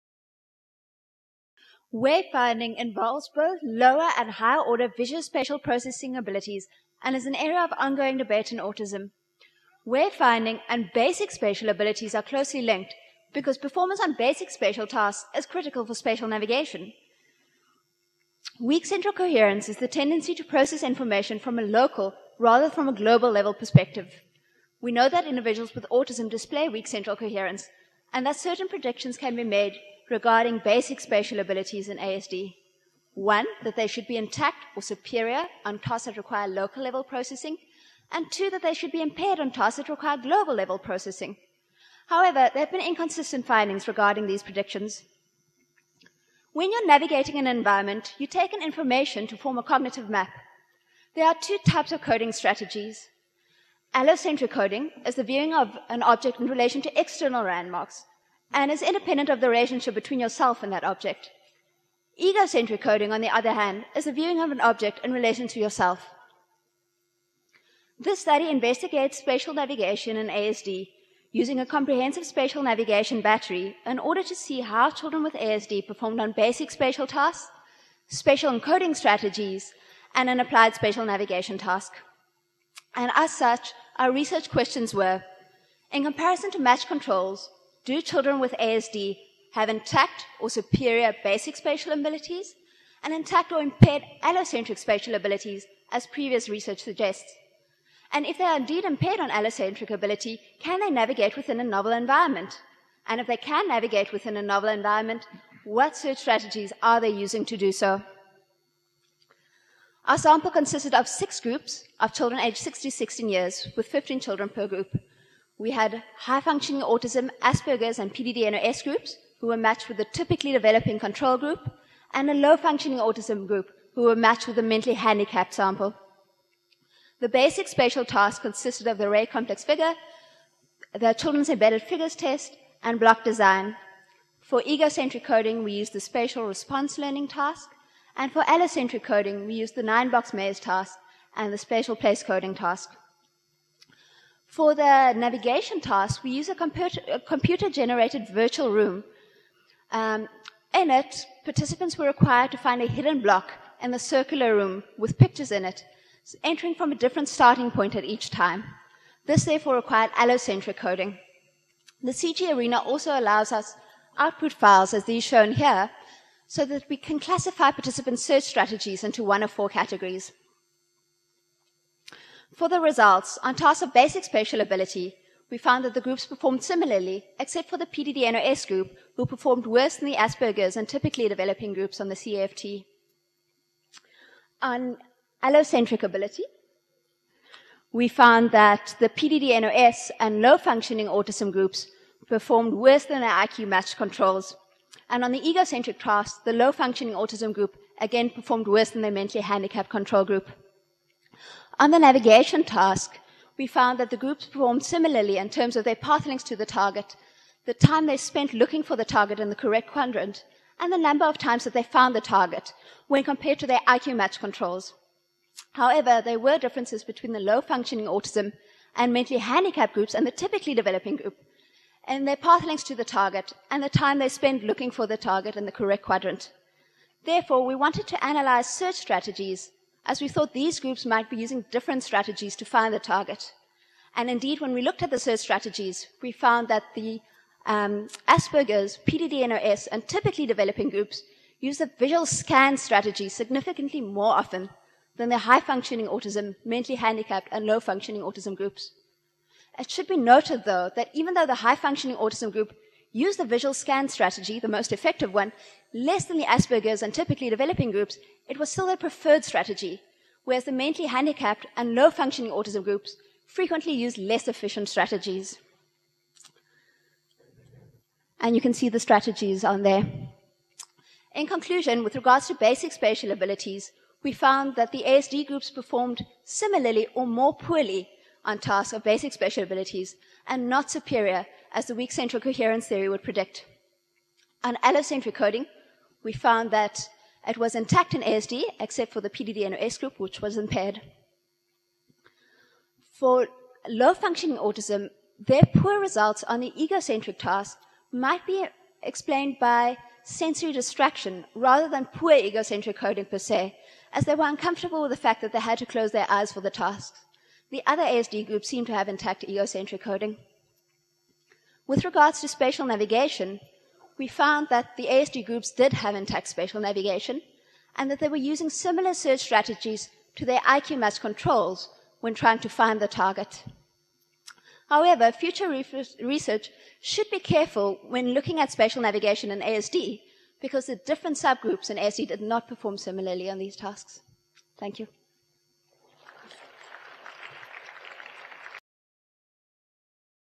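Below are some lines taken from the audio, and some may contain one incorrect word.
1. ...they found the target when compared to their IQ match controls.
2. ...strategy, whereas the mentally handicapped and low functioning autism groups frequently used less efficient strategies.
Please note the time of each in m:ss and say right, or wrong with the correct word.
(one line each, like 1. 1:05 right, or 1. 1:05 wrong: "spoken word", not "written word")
1. 3:31 right
2. 4:19 right.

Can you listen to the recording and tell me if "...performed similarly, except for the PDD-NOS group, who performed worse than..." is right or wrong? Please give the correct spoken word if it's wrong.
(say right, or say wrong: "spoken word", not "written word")
right.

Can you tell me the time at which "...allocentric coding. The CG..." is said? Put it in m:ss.
2:40.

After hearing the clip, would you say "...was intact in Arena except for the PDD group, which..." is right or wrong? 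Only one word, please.
wrong.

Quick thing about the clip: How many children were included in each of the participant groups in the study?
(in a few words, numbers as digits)
15.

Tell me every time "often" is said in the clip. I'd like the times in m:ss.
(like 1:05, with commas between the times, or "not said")
4:04.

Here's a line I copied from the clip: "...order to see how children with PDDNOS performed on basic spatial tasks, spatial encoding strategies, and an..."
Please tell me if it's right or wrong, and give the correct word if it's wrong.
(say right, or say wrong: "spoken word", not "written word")
wrong: "ASD", not "PDDNOS".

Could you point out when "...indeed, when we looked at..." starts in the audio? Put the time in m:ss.
3:54.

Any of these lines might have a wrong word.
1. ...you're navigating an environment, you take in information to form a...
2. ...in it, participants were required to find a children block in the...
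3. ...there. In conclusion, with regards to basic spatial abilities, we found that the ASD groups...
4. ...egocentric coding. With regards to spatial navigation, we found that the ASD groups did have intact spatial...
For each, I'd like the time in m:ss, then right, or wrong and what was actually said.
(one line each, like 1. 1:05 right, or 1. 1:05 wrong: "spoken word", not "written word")
1. 0:46 right
2. 2:30 wrong: "hidden", not "children"
3. 4:29 right
4. 5:09 right.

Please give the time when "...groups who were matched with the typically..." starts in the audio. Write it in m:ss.
1:58.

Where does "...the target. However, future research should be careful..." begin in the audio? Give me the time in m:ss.
5:22.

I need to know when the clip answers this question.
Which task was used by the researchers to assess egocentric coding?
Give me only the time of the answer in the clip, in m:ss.
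2:15.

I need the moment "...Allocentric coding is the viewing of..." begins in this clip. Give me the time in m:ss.
0:53.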